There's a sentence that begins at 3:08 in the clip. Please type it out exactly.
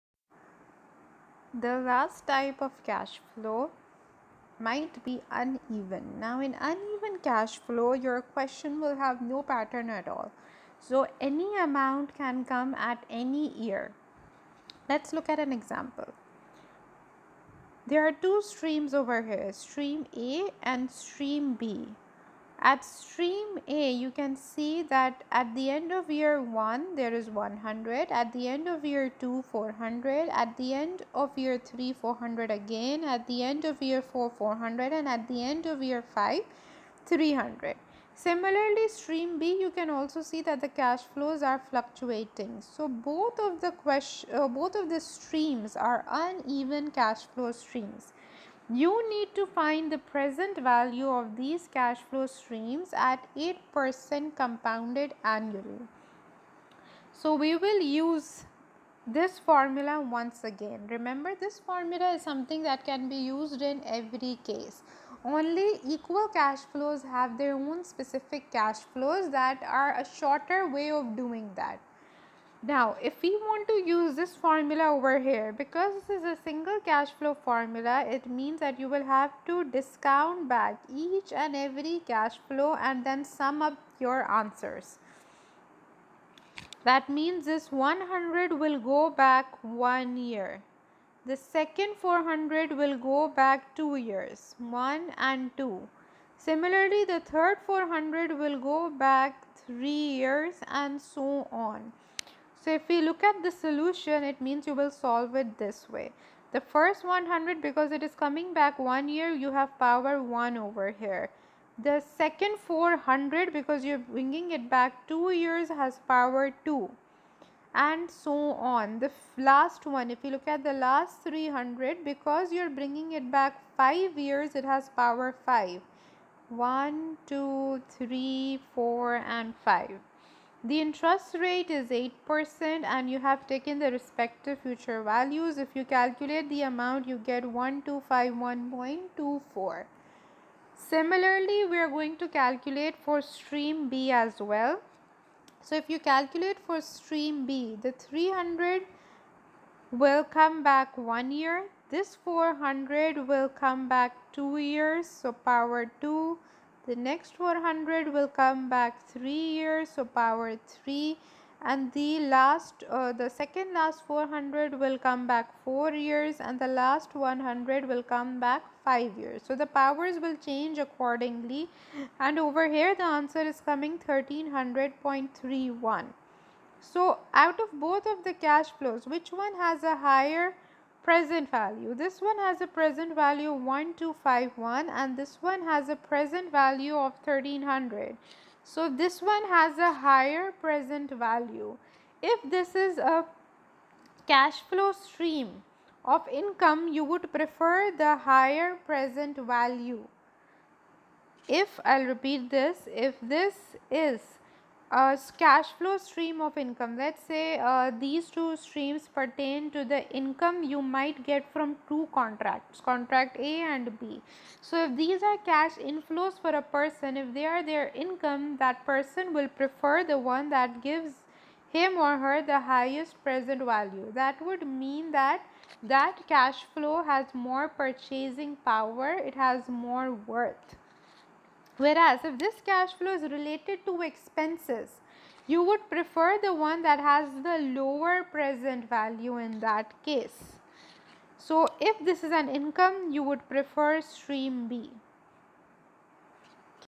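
So this one has a higher present value.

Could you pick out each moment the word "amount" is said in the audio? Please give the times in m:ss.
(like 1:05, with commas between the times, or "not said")
0:11, 2:16.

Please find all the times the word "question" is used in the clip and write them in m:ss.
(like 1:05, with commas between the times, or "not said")
0:08, 0:43.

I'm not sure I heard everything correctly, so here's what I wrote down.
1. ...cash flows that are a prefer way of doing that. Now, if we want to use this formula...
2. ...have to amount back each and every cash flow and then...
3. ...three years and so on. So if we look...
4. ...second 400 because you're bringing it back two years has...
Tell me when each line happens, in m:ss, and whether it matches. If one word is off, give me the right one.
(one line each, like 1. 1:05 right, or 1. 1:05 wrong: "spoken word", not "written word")
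1. 1:08 wrong: "shorter", not "prefer"
2. 1:19 wrong: "discount", not "amount"
3. 1:39 right
4. 1:52 right.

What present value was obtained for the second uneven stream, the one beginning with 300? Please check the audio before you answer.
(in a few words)
1300.31.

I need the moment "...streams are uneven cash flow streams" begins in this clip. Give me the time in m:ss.
0:44.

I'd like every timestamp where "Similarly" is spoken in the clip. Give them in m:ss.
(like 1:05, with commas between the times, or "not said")
0:38, 1:36, 2:20.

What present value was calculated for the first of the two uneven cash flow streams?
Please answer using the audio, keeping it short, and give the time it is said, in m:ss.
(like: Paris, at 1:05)
1251.24, at 2:17.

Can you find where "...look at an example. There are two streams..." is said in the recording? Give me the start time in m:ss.
0:15.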